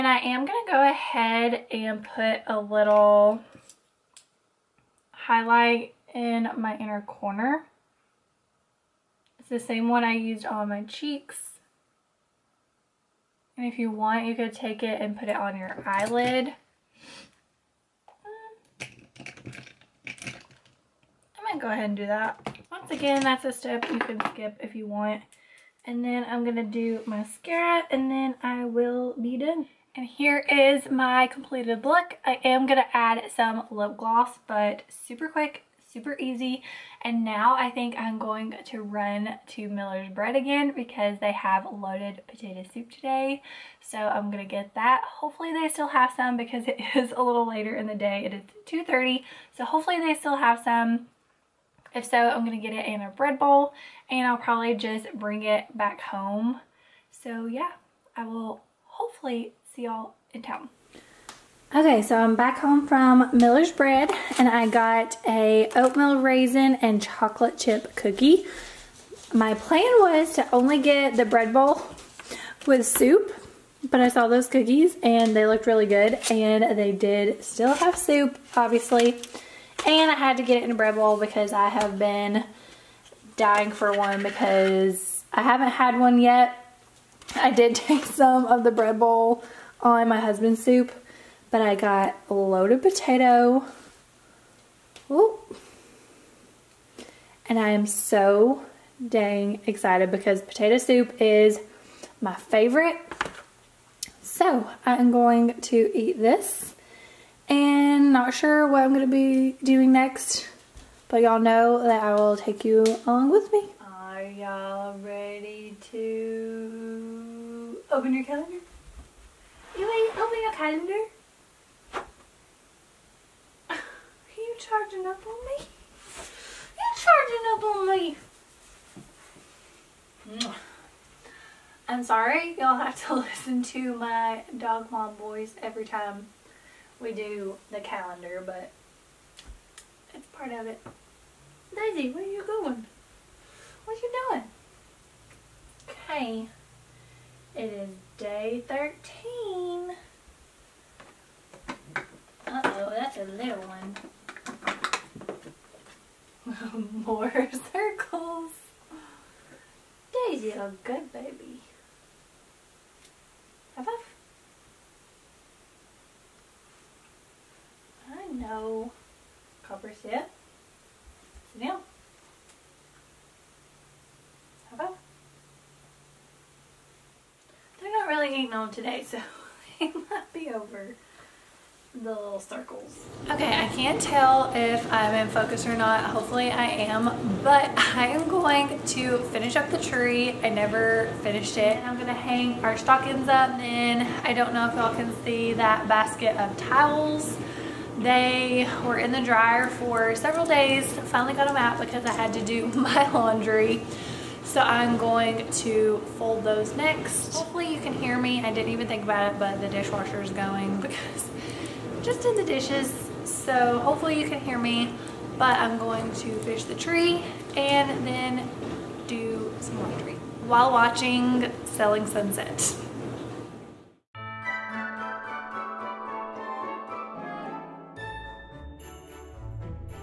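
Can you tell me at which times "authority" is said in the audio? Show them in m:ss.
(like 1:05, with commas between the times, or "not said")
not said.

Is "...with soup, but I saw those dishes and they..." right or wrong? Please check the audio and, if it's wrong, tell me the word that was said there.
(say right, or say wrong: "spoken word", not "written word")
wrong: "cookies", not "dishes".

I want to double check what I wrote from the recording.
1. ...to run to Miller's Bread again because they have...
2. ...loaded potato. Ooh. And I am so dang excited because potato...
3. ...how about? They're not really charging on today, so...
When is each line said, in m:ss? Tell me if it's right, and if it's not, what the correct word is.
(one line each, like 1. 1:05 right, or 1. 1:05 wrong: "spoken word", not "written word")
1. 0:38 right
2. 1:32 right
3. 2:54 wrong: "eating", not "charging".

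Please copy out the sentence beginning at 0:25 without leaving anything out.
And then I'm gonna do mascara and then I will be done.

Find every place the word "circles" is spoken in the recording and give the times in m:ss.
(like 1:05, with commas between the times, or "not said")
2:37, 3:02.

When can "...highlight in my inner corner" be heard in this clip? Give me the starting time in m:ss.
0:05.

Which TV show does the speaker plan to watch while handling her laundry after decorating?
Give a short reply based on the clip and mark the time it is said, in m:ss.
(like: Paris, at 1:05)
Selling Sunset, at 3:41.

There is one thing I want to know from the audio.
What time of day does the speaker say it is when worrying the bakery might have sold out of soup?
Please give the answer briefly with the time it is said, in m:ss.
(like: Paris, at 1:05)
2:30, at 0:48.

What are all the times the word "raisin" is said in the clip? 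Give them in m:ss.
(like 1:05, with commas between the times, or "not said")
1:06.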